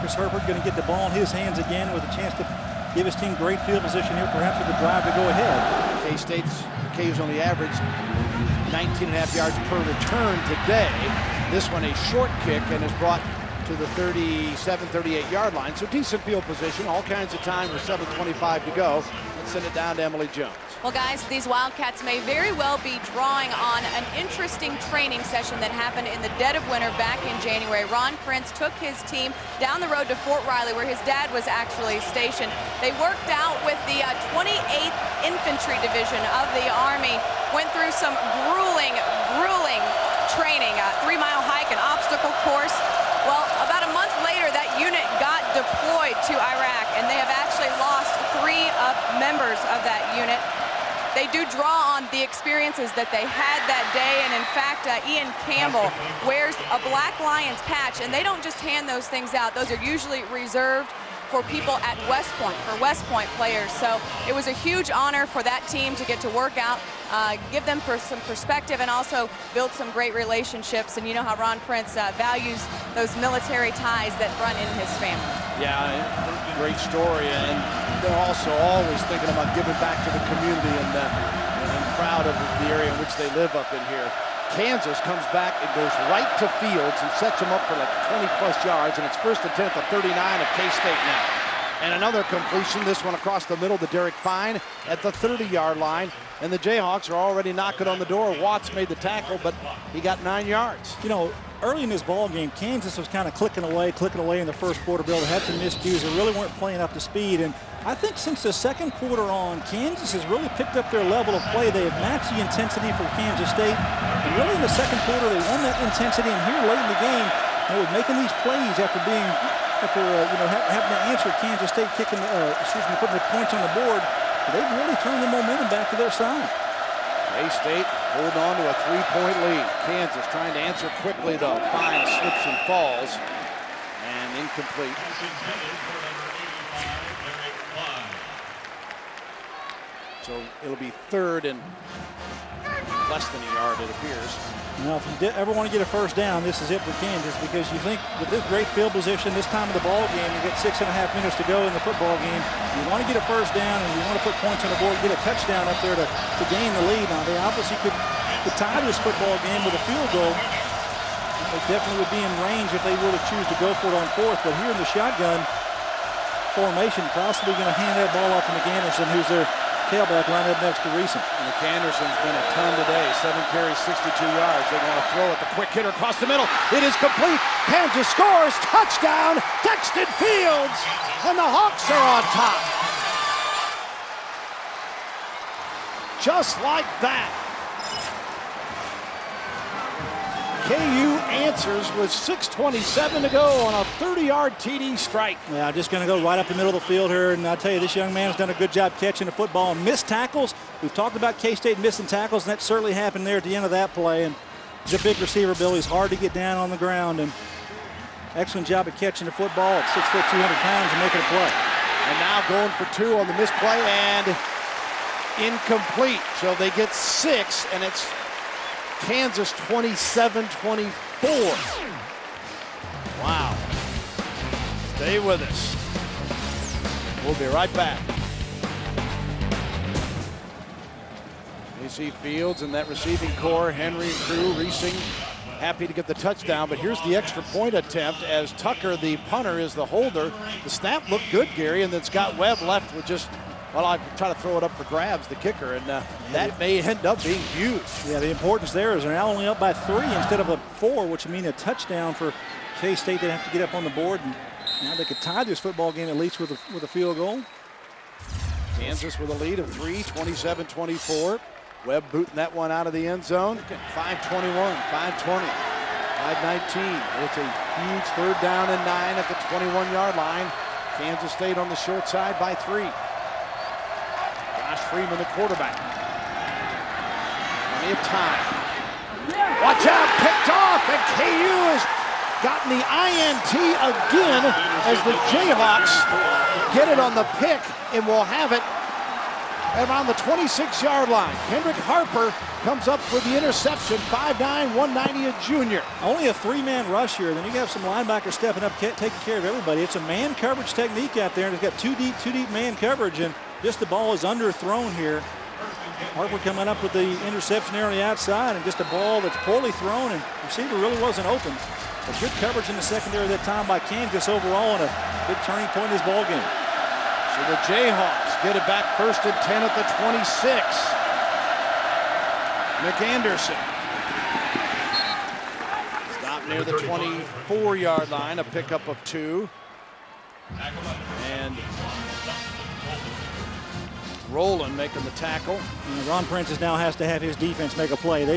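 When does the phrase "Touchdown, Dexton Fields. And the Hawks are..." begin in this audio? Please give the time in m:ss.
2:58.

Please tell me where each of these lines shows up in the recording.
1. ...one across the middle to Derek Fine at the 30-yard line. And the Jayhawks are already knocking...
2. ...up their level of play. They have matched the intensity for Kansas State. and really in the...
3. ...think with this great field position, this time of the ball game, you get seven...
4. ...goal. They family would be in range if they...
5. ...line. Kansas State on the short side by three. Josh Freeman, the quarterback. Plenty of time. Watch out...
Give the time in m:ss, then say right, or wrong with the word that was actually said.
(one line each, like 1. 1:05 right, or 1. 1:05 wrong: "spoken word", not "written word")
1. 1:33 right
2. 1:50 right
3. 2:27 wrong: "six", not "seven"
4. 2:40 wrong: "definitely", not "family"
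5. 4:30 right.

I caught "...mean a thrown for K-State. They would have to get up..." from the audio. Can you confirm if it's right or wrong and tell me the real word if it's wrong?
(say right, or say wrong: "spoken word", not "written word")
wrong: "touchdown", not "thrown".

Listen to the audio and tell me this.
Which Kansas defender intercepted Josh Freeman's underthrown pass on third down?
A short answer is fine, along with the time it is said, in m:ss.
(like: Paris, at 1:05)
Kendrick Harper, at 4:51.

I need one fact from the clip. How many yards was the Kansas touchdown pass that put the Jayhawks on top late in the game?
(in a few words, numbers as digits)
30.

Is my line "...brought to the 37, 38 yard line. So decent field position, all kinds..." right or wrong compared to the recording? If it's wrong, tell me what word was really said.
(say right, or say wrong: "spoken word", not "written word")
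right.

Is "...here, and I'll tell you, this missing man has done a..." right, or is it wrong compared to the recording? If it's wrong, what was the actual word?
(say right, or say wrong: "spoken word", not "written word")
wrong: "young", not "missing".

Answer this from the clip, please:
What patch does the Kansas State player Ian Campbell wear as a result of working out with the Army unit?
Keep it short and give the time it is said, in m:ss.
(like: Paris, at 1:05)
Black Lions, at 0:56.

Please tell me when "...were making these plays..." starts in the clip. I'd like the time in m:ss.
1:57.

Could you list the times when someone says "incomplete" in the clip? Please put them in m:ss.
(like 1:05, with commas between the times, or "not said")
2:14, 3:35.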